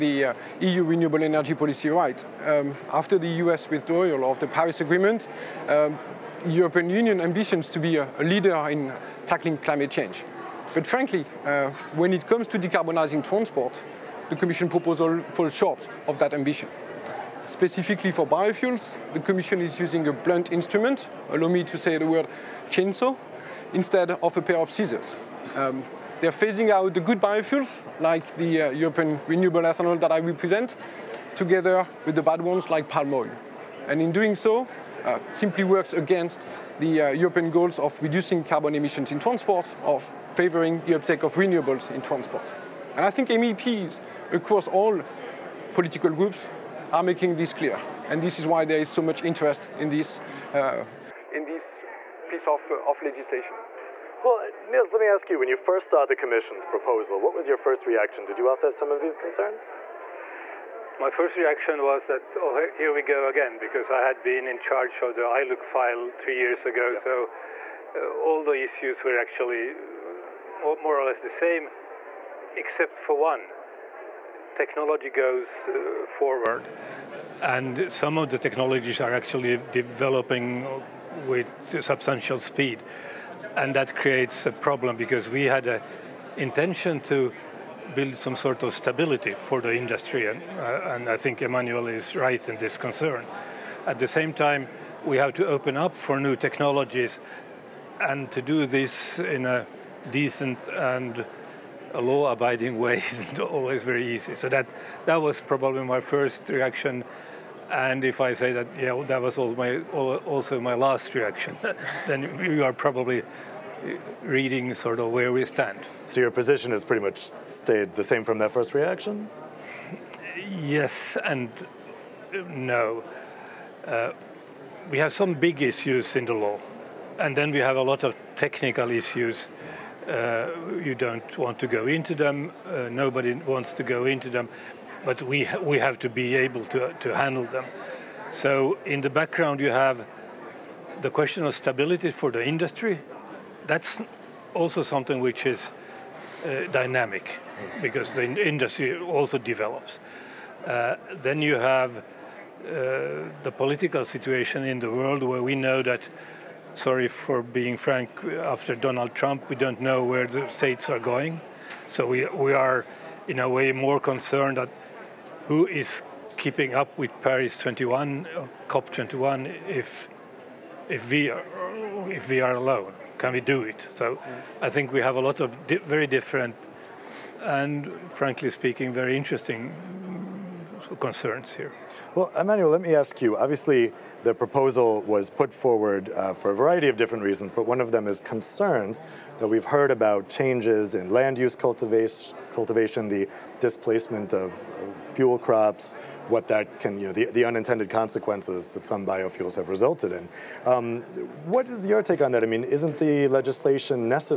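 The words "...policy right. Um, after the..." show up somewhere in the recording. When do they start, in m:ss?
0:01.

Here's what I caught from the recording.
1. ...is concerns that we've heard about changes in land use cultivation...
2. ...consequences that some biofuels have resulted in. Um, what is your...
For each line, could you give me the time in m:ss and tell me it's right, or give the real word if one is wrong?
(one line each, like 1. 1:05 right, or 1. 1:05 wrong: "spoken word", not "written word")
1. 3:08 right
2. 3:17 right.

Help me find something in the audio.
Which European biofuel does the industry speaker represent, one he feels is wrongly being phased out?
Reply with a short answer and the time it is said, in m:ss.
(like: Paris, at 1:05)
European renewable ethanol, at 0:28.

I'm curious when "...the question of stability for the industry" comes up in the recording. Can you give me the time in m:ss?
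2:21.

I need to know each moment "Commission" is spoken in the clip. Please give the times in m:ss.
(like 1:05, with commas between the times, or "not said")
0:14, 0:19, 0:56.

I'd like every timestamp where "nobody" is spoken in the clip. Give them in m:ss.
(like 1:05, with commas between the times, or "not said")
2:12.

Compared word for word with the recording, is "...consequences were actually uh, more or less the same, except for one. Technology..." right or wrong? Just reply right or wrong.
wrong.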